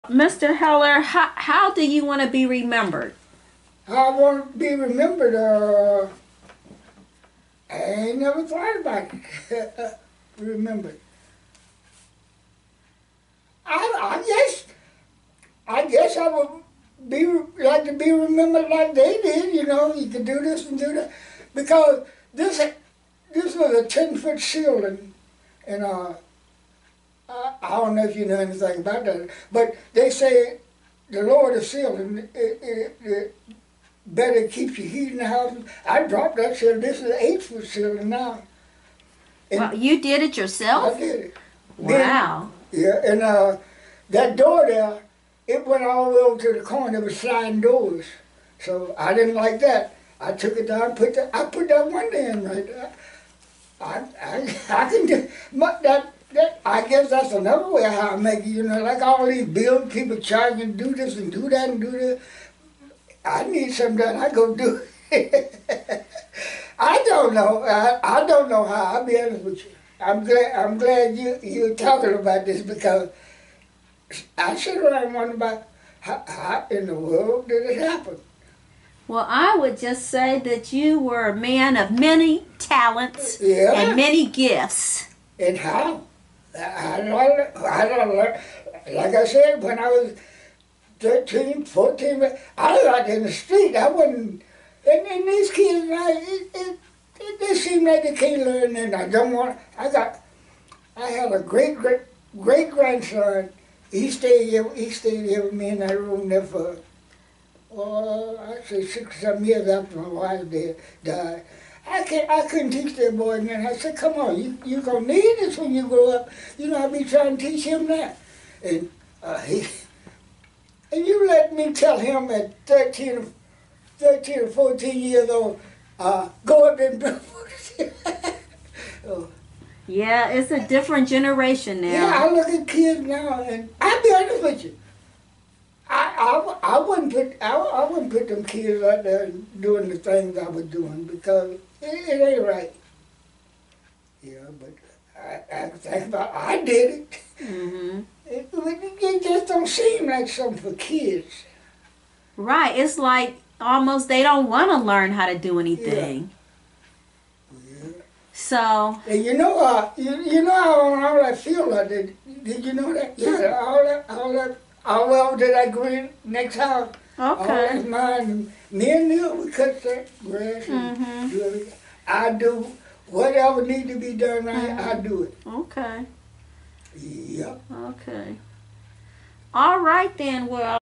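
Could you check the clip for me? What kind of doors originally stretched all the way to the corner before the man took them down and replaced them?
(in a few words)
Sliding doors.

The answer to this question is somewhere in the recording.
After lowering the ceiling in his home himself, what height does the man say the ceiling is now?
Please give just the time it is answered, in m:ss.
0:37.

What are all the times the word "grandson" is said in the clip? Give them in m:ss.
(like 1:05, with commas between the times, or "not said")
1:42.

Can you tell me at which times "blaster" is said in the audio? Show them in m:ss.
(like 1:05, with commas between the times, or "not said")
not said.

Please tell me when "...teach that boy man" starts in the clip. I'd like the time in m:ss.
1:52.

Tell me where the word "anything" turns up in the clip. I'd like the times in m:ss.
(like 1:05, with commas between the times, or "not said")
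0:28, 2:35.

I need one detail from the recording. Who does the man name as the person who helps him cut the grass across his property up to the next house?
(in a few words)
Neil.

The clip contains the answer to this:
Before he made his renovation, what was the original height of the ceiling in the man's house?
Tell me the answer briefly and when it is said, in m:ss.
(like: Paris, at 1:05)
10 foot, at 0:23.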